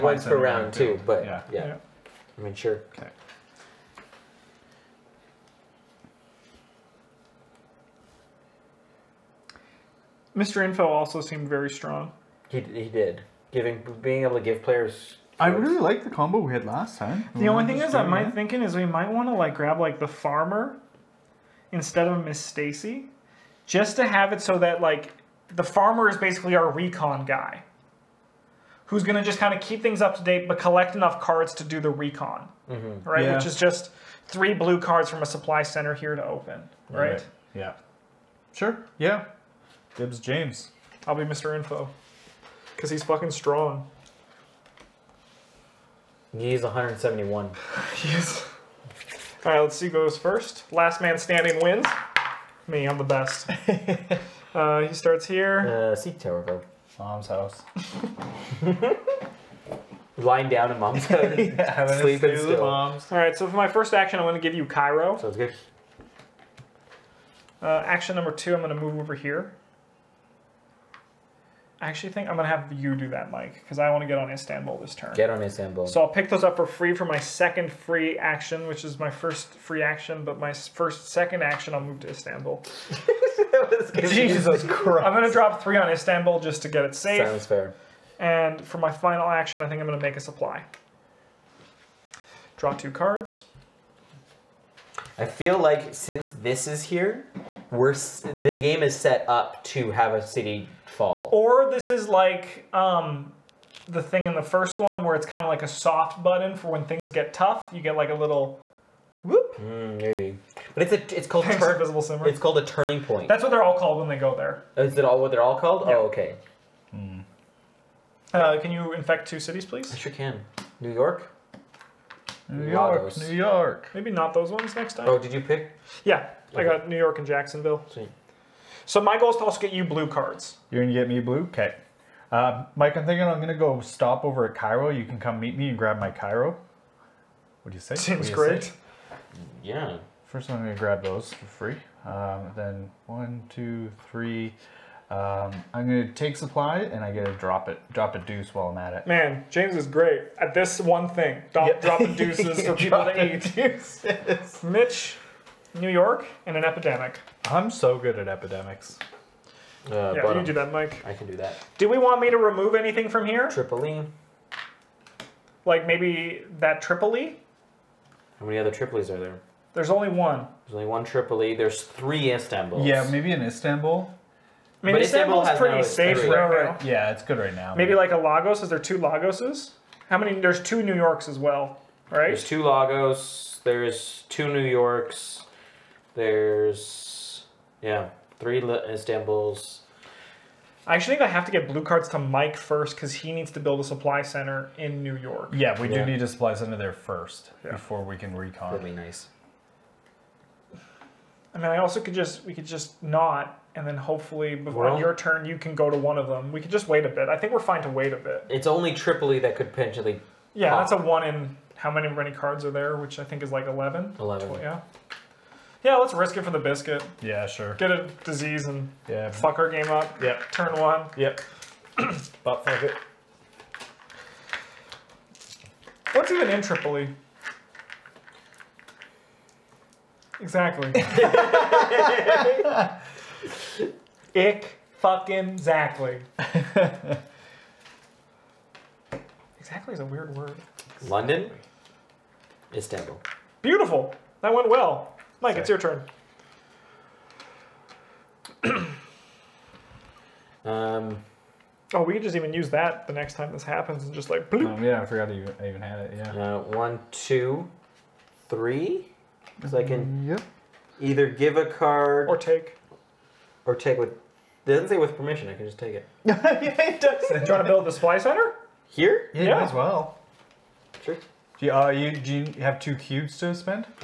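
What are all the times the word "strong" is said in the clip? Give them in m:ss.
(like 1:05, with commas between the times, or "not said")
0:11, 0:43.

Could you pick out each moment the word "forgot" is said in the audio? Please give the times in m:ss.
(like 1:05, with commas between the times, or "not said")
4:15.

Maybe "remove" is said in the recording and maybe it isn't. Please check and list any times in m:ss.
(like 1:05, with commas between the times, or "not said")
2:42.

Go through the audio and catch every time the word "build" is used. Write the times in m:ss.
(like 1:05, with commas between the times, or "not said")
3:13, 4:27.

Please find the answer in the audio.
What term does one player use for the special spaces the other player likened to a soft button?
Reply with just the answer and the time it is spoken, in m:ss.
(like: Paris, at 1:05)
Turning point, at 1:52.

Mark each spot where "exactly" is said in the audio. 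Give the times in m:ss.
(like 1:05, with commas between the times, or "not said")
3:50, 3:55, 3:59.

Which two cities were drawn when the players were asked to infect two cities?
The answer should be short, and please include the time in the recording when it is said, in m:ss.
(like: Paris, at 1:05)
New York and Jacksonville, at 2:06.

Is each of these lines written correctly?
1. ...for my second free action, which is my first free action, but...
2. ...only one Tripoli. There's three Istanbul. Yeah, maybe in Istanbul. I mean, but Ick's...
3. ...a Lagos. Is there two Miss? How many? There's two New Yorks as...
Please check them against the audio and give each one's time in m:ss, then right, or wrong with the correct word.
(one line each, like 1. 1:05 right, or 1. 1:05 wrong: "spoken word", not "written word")
1. 1:16 right
2. 2:50 wrong: "Istanbul", not "Ick"
3. 2:58 wrong: "Lagoses", not "Miss".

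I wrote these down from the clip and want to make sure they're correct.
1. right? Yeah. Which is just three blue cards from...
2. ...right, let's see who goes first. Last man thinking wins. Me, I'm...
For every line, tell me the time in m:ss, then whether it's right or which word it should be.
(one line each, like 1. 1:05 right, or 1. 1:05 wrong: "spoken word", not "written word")
1. 0:33 right
2. 0:49 wrong: "standing", not "thinking".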